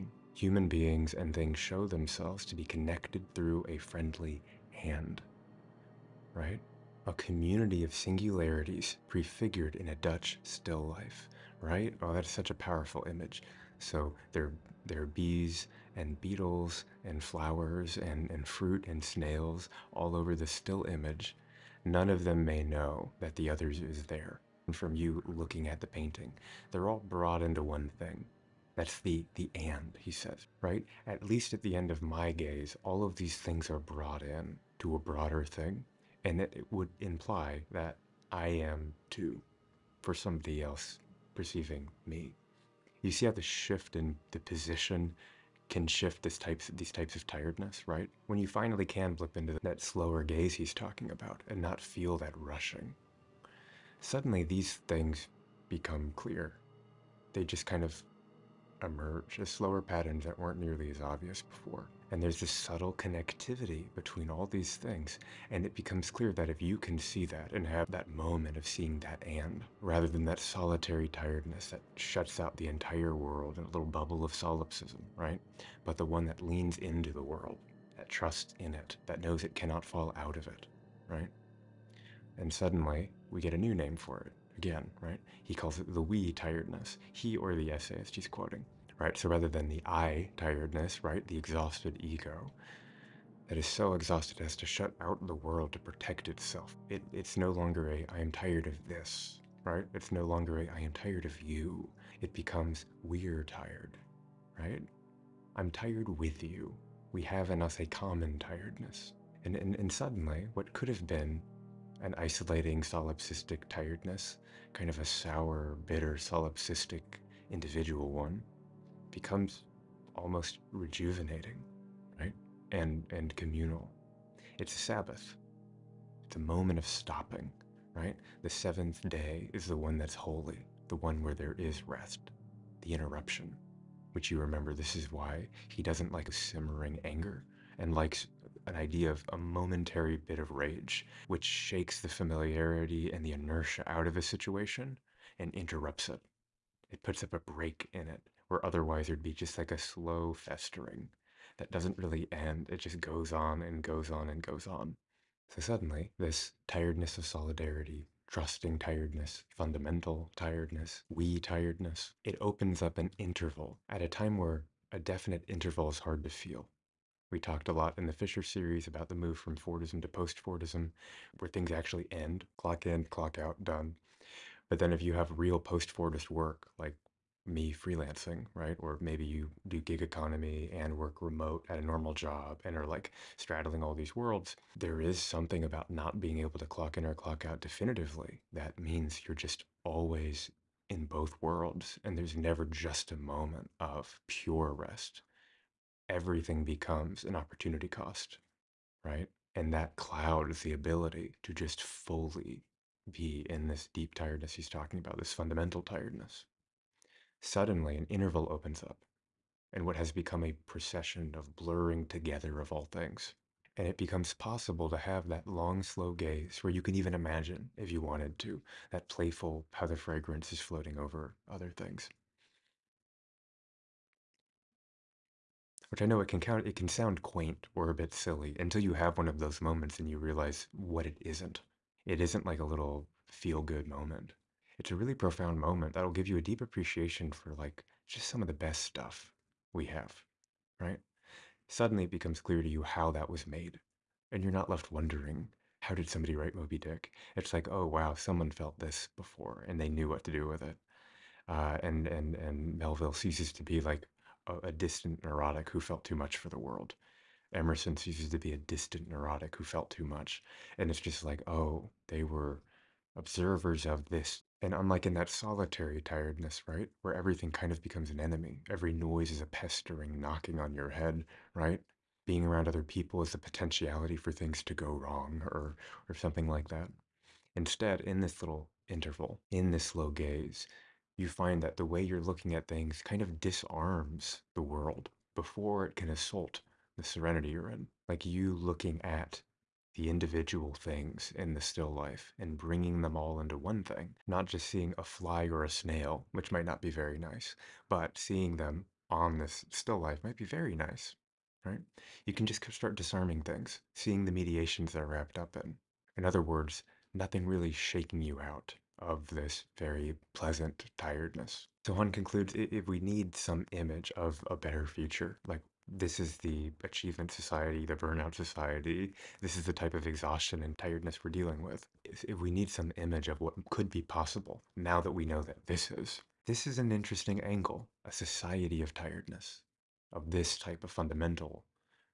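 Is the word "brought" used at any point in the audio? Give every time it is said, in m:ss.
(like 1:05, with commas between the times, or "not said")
0:27, 0:33.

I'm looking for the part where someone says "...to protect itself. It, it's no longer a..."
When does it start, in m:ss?
1:35.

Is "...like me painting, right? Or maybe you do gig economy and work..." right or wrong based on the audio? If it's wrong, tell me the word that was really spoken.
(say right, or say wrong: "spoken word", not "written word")
wrong: "freelancing", not "painting".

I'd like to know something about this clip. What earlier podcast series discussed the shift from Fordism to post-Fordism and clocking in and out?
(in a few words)
Fisher series.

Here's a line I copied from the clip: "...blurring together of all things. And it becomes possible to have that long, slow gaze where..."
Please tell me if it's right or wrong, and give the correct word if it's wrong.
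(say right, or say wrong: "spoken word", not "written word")
right.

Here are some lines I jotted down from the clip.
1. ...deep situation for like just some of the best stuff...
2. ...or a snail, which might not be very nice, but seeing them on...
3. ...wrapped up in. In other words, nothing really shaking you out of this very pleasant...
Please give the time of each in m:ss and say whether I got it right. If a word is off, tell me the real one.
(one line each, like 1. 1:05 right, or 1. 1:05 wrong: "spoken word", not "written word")
1. 3:56 wrong: "appreciation", not "situation"
2. 4:55 right
3. 5:05 right.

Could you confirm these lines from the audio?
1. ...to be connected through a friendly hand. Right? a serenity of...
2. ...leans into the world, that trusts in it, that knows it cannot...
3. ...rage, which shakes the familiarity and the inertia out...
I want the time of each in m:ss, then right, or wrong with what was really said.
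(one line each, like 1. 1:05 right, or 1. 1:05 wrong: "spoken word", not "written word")
1. 0:02 wrong: "community", not "serenity"
2. 1:16 right
3. 2:20 right.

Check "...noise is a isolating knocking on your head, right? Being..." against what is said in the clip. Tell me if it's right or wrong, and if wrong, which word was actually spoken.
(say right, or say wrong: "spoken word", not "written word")
wrong: "pestering", not "isolating".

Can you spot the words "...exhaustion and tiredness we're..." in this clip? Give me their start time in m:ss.
5:20.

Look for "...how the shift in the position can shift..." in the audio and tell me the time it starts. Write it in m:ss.
0:43.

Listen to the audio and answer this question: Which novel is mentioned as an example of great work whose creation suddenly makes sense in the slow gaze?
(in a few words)
Moby Dick.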